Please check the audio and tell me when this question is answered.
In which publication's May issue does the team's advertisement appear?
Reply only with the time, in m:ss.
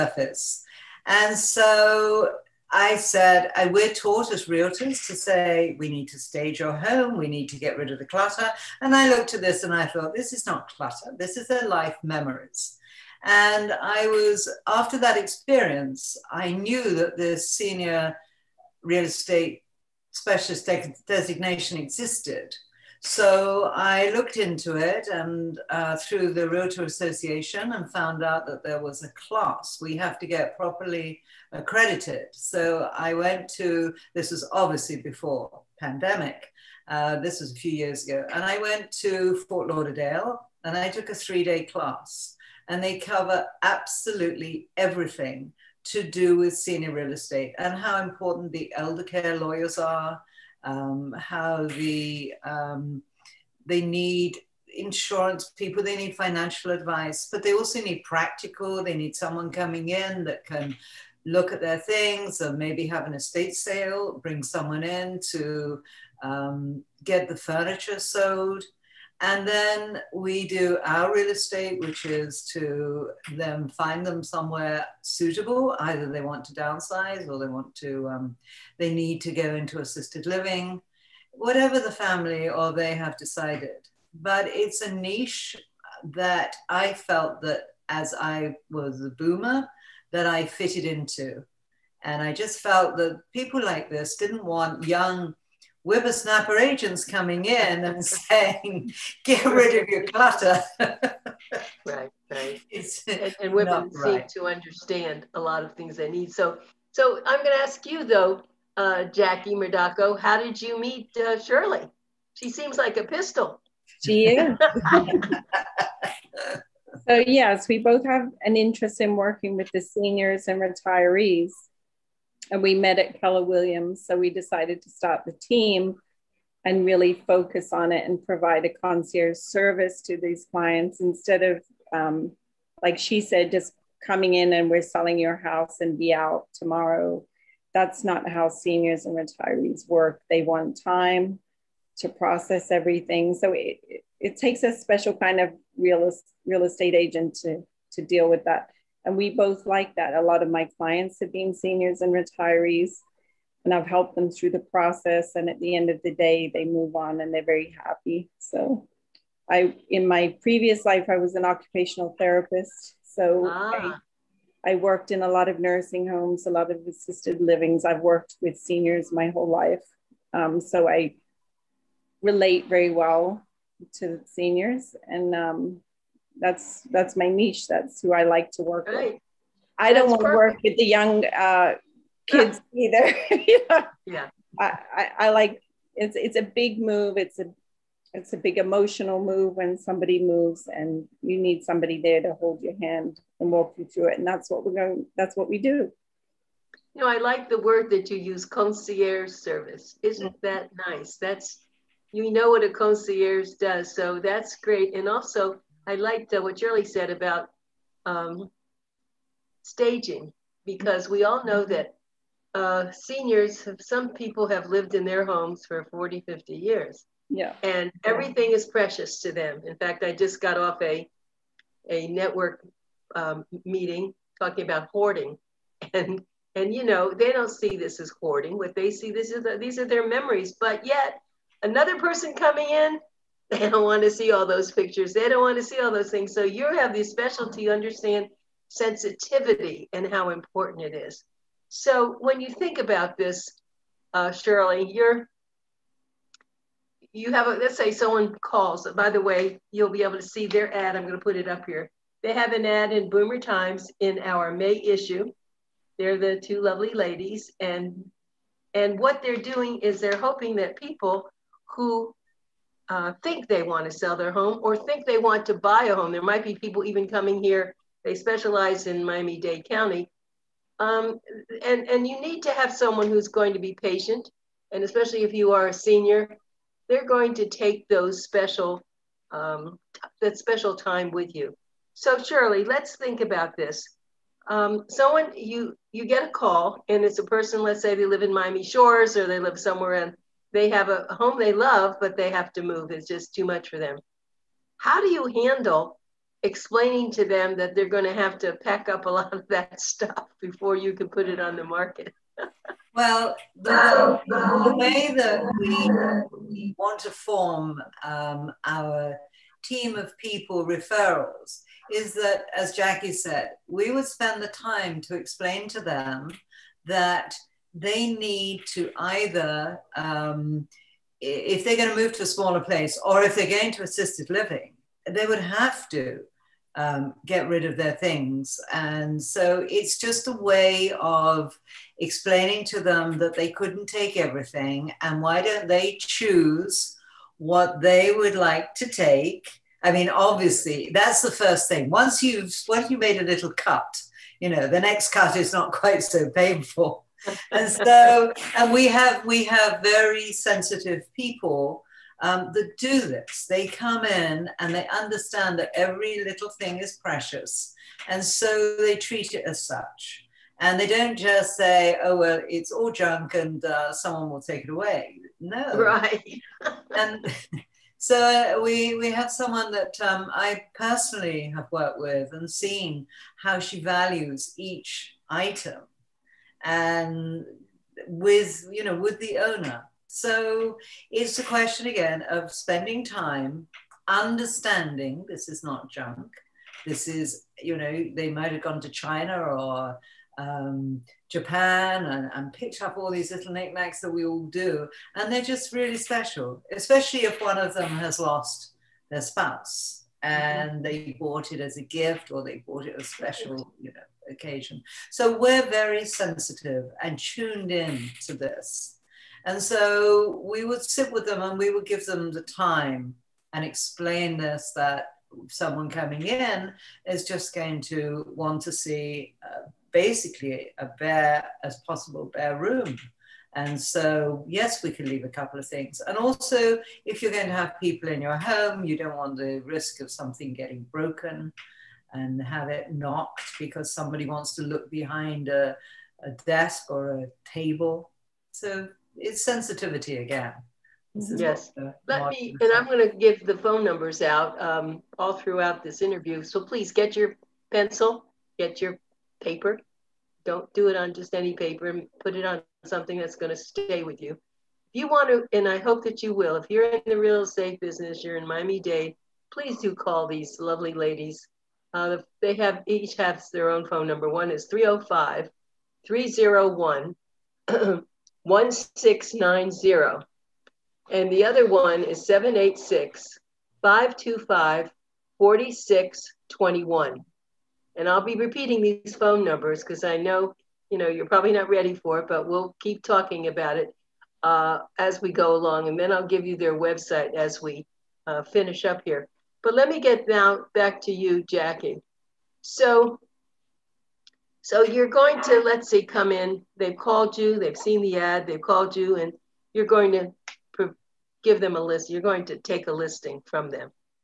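4:13.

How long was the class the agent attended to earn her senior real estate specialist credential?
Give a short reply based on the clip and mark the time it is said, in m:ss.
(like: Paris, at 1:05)
3 days, at 0:41.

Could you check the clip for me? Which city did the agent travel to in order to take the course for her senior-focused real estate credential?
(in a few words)
Fort Lauderdale.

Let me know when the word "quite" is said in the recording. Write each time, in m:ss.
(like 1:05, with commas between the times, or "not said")
5:45.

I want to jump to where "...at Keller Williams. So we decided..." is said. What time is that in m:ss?
2:02.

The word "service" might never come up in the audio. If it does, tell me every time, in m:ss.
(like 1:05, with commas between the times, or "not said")
2:09, 3:19.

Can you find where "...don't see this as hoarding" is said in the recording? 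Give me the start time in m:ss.
3:47.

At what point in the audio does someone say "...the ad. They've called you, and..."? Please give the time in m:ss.
8:17.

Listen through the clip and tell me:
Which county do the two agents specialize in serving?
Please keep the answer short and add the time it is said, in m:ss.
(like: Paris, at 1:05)
Miami Dade County, at 4:29.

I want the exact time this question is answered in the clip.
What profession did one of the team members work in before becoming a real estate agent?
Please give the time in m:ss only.
2:41.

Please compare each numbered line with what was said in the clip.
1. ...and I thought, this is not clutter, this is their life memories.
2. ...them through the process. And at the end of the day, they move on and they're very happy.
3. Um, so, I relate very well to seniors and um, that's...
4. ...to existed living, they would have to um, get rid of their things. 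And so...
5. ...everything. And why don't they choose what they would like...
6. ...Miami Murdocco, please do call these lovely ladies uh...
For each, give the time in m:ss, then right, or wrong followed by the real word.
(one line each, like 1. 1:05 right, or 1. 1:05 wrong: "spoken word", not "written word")
1. 0:09 right
2. 2:34 right
3. 2:50 right
4. 5:23 wrong: "assisted", not "existed"
5. 5:34 right
6. 7:38 wrong: "Dade", not "Murdocco".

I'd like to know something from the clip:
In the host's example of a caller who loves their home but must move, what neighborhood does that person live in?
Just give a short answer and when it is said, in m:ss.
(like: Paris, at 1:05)
Miami Shores, at 4:48.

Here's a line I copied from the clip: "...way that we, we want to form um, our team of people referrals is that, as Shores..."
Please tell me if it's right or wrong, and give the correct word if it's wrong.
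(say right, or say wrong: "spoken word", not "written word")
wrong: "Jacqui", not "Shores".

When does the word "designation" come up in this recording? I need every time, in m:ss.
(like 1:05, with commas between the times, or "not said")
0:21.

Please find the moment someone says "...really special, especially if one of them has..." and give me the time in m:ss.
6:35.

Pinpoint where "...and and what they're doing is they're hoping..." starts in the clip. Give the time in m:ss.
4:17.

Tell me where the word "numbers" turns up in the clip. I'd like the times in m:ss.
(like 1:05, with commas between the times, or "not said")
7:23, 7:44, 7:59.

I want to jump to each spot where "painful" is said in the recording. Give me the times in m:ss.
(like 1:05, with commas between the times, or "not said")
5:46.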